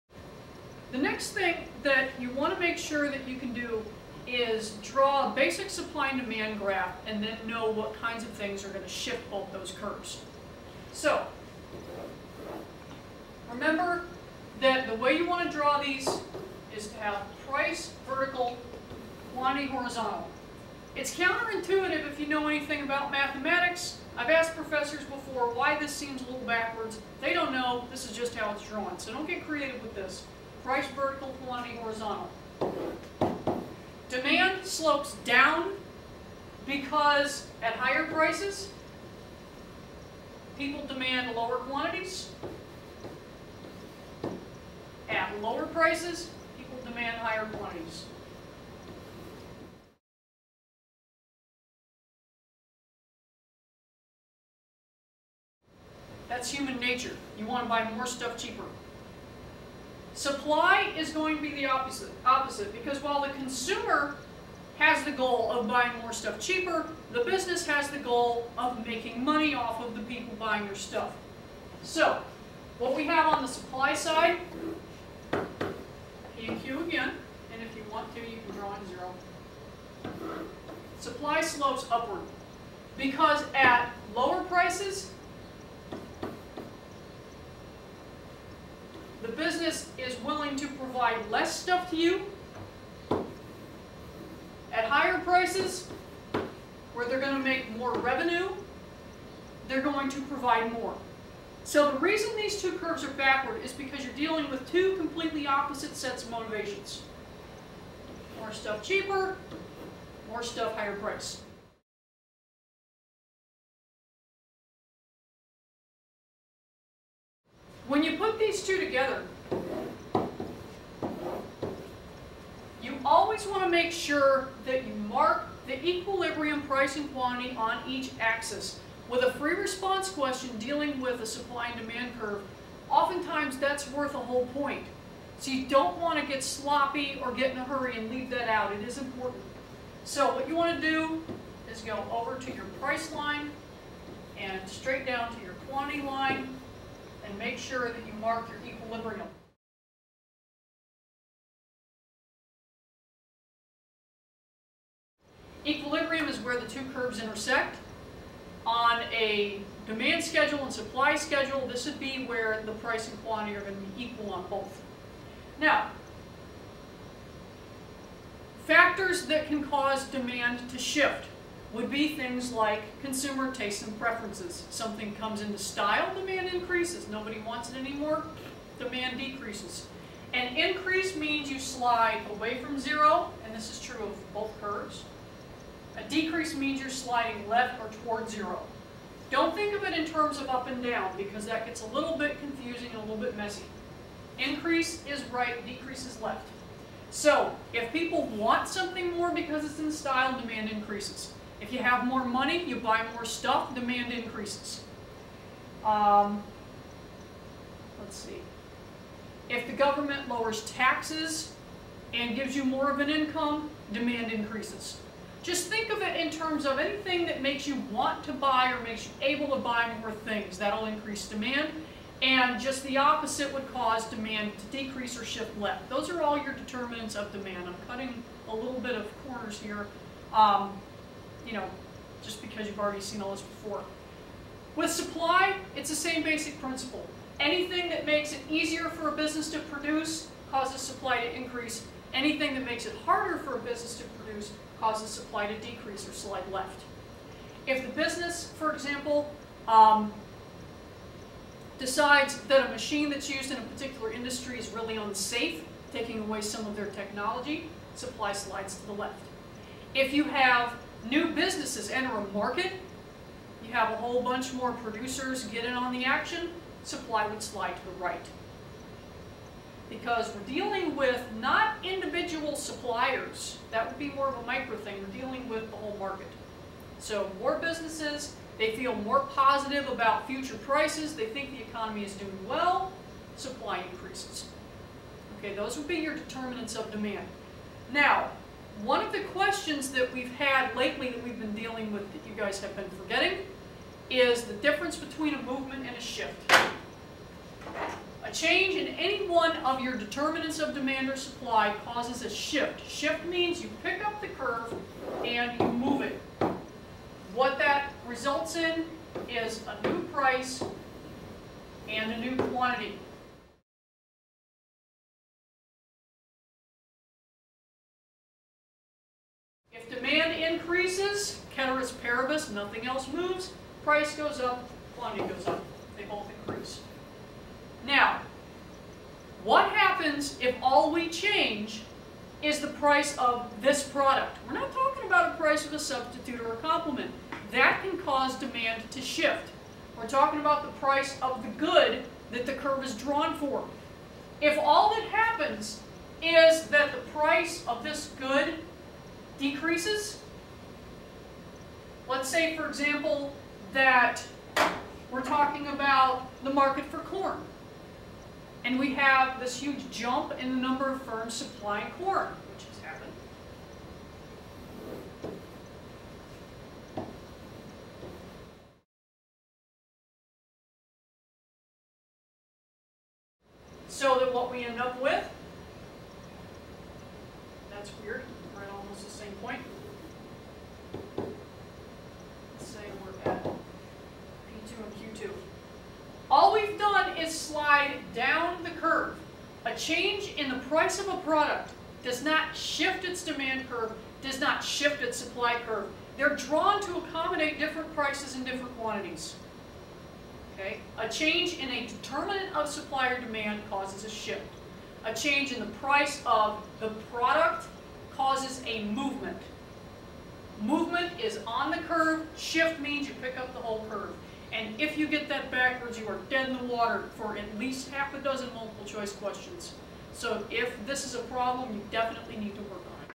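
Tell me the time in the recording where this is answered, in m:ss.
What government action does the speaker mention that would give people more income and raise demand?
3:30.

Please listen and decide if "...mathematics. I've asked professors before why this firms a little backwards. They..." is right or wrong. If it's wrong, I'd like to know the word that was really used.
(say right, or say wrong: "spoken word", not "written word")
wrong: "seems", not "firms".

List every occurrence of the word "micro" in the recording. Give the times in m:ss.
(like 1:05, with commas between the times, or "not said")
4:34.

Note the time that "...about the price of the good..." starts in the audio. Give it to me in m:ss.
5:40.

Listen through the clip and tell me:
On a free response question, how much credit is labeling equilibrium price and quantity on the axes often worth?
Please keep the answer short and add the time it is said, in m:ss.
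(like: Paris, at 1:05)
a whole point, at 2:14.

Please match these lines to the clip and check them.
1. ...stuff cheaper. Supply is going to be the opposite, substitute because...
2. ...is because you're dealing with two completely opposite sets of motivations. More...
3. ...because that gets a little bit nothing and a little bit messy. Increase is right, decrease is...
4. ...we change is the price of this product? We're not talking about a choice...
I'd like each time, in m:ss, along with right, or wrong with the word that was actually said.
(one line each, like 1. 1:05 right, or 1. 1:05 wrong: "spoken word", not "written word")
1. 0:58 wrong: "opposite", not "substitute"
2. 1:43 right
3. 3:11 wrong: "confusing", not "nothing"
4. 5:30 wrong: "price", not "choice".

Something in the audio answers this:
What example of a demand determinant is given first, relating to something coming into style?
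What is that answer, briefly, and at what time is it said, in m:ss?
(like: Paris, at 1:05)
consumer tastes and preferences, at 2:53.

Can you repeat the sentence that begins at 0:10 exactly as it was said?
So, remember that the way you want to draw these is to have price vertical, quantity horizontal.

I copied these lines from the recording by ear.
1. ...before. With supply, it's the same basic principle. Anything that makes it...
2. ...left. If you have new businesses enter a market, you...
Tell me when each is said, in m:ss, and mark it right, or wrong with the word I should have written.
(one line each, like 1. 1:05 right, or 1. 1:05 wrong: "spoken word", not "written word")
1. 3:53 right
2. 4:18 right.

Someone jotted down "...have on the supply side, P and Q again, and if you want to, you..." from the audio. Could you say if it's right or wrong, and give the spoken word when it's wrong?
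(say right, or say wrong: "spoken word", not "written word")
right.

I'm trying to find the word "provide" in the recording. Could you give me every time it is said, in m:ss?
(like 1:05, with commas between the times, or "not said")
1:30, 1:40.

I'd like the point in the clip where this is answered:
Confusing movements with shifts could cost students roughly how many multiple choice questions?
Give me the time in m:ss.
6:57.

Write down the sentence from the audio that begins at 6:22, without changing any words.
Let's say we're at P2 and Q2.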